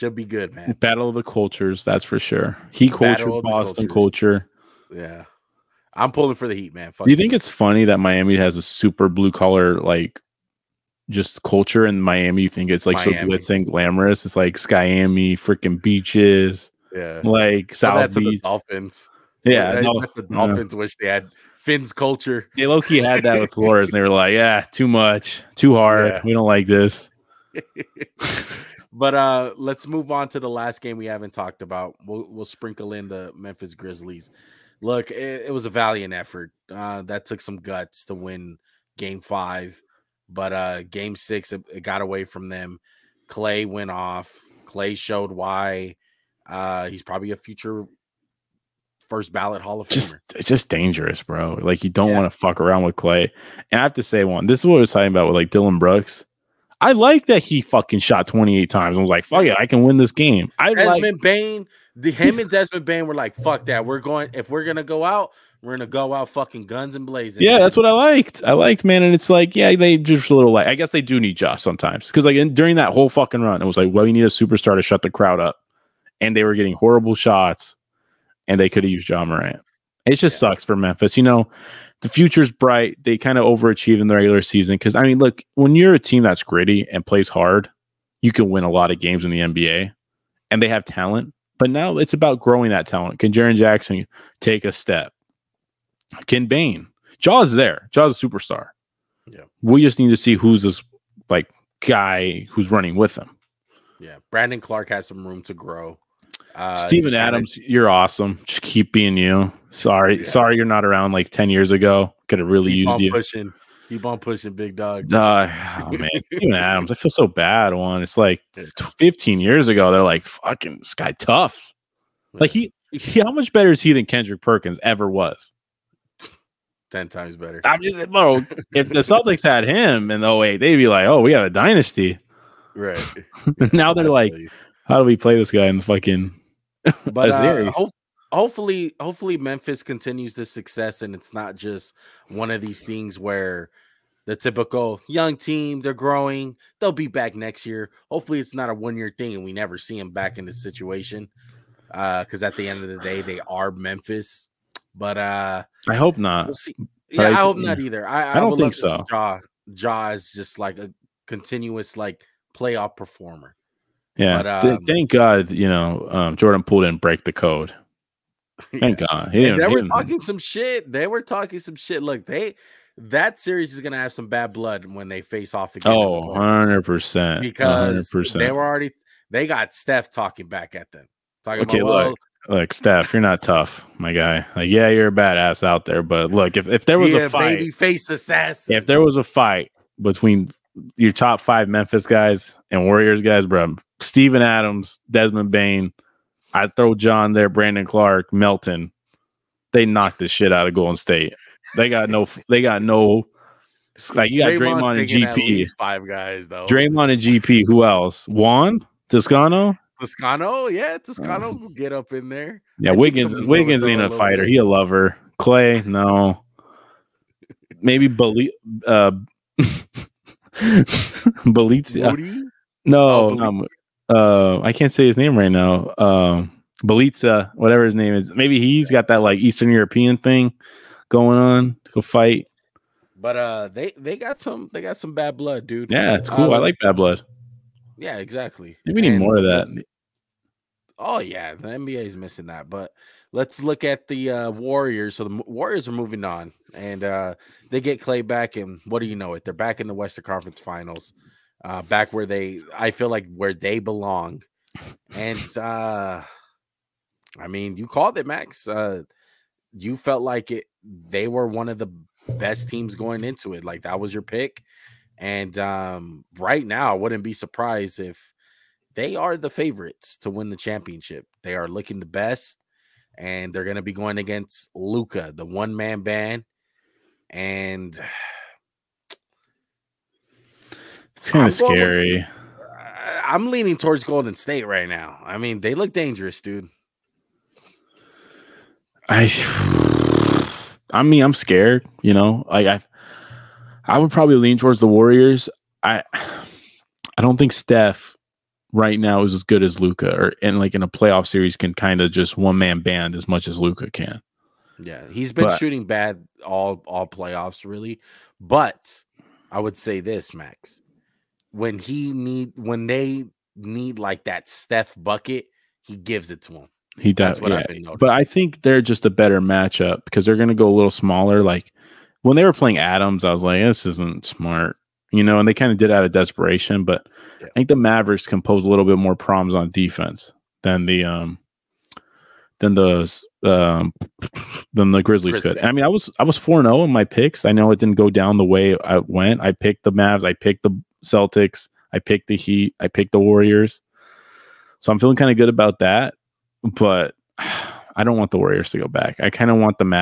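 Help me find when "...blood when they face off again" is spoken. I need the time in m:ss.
2:54.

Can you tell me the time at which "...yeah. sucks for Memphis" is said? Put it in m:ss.
1:20.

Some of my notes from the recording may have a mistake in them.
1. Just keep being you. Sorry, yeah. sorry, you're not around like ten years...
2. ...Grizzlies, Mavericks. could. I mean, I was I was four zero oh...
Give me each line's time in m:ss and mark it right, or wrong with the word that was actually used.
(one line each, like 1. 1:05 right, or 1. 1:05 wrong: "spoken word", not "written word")
1. 1:48 right
2. 5:35 wrong: "Grizzlies", not "Mavericks".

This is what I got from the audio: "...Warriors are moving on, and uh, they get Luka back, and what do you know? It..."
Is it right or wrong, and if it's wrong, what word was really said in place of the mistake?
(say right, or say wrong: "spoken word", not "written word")
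wrong: "Klay", not "Luka".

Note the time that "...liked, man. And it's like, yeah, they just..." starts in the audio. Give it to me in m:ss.
1:08.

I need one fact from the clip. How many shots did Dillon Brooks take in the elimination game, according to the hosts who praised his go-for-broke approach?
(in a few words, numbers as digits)
28.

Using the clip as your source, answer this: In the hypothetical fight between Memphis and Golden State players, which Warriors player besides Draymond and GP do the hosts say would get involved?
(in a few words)
Juan Toscano.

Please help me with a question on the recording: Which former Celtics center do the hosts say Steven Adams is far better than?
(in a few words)
Kendrick Perkins.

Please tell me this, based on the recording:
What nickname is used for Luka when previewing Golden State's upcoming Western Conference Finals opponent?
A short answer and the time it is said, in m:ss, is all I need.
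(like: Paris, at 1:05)
the one man band, at 4:35.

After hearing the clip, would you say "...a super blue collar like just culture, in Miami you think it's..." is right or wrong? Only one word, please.
right.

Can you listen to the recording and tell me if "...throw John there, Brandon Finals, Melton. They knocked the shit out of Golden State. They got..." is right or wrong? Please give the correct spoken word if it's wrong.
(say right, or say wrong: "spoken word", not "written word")
wrong: "Clarke", not "Finals".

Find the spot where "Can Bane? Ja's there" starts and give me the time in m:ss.
1:36.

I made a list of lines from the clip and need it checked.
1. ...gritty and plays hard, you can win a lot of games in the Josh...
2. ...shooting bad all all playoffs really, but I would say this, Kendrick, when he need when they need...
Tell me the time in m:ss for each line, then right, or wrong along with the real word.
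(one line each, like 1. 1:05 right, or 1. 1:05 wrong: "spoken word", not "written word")
1. 1:26 wrong: "NBA", not "Josh"
2. 5:05 wrong: "Max", not "Kendrick".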